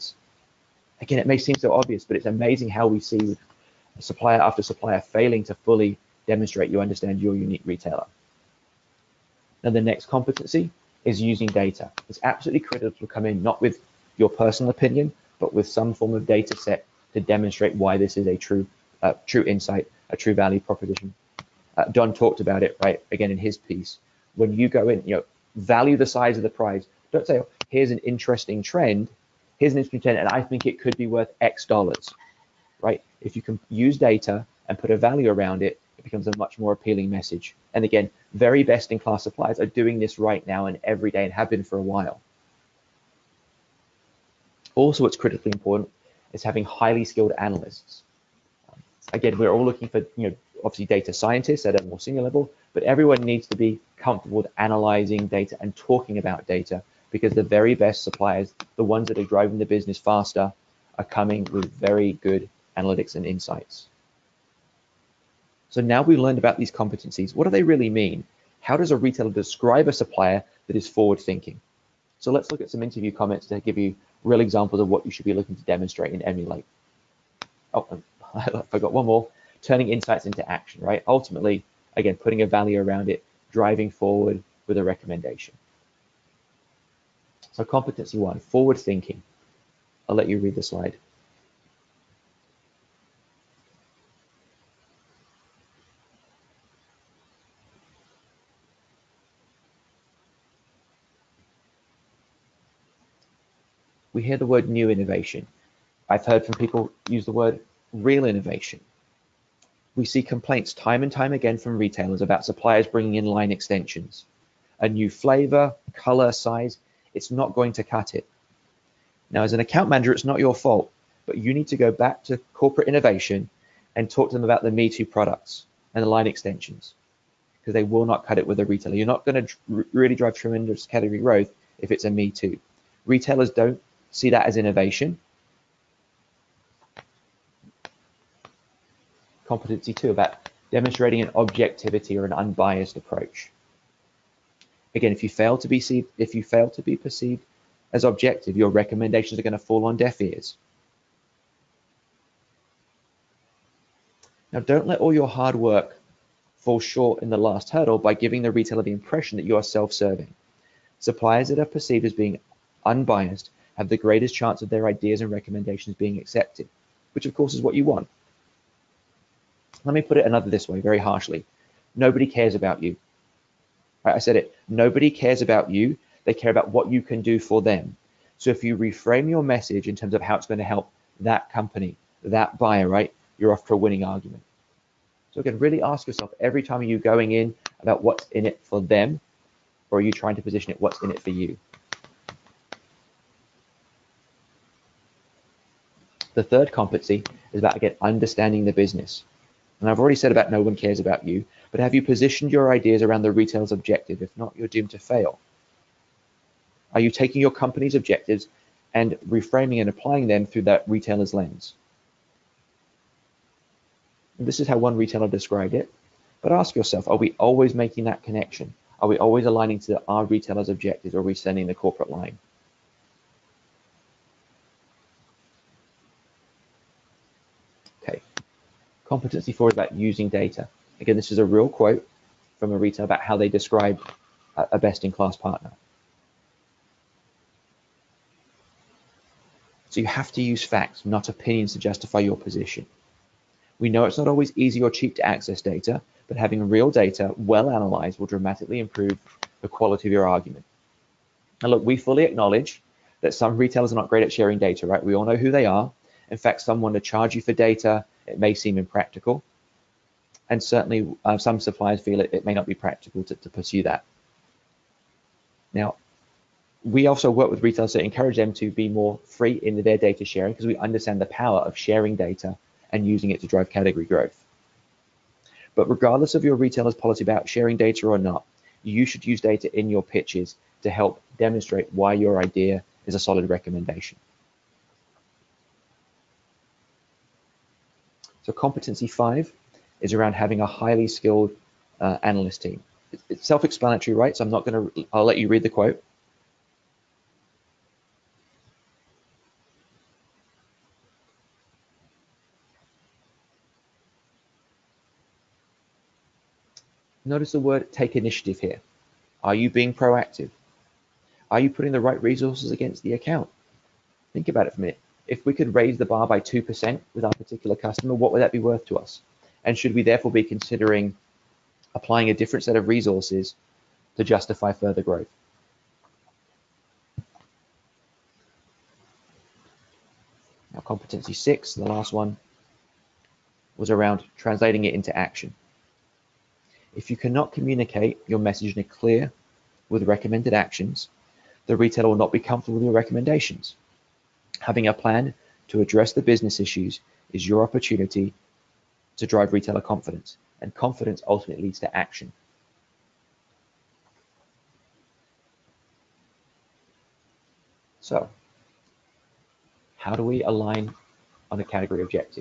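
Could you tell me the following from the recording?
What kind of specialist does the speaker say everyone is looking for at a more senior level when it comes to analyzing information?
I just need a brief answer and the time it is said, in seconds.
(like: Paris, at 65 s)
Data scientists, at 50 s.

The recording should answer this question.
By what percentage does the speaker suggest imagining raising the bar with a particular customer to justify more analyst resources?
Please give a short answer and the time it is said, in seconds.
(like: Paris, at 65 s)
2%, at 316 s.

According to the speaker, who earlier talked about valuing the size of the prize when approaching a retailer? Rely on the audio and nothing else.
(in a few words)
Don.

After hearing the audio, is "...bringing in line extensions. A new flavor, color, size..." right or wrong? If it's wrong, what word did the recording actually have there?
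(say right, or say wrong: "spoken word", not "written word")
right.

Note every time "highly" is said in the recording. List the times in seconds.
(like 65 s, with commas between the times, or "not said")
46 s, 290 s.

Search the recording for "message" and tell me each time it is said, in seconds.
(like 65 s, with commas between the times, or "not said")
37 s, 179 s, 338 s.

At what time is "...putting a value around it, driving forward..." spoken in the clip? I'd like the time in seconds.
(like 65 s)
82 s.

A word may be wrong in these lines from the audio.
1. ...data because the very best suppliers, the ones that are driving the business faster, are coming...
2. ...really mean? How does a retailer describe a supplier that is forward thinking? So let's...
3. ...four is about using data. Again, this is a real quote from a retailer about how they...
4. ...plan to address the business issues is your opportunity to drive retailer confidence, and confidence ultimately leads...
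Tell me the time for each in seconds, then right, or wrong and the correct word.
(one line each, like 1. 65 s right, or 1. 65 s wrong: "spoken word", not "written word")
1. 56 s right
2. 67 s right
3. 229 s right
4. 344 s right.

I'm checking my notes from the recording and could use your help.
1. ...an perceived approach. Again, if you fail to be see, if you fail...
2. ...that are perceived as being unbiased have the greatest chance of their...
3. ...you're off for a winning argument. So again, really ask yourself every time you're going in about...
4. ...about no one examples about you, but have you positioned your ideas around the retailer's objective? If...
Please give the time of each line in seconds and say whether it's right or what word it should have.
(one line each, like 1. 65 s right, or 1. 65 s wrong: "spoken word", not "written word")
1. 142 s wrong: "unbiased", not "perceived"
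2. 161 s right
3. 183 s right
4. 200 s wrong: "cares", not "examples".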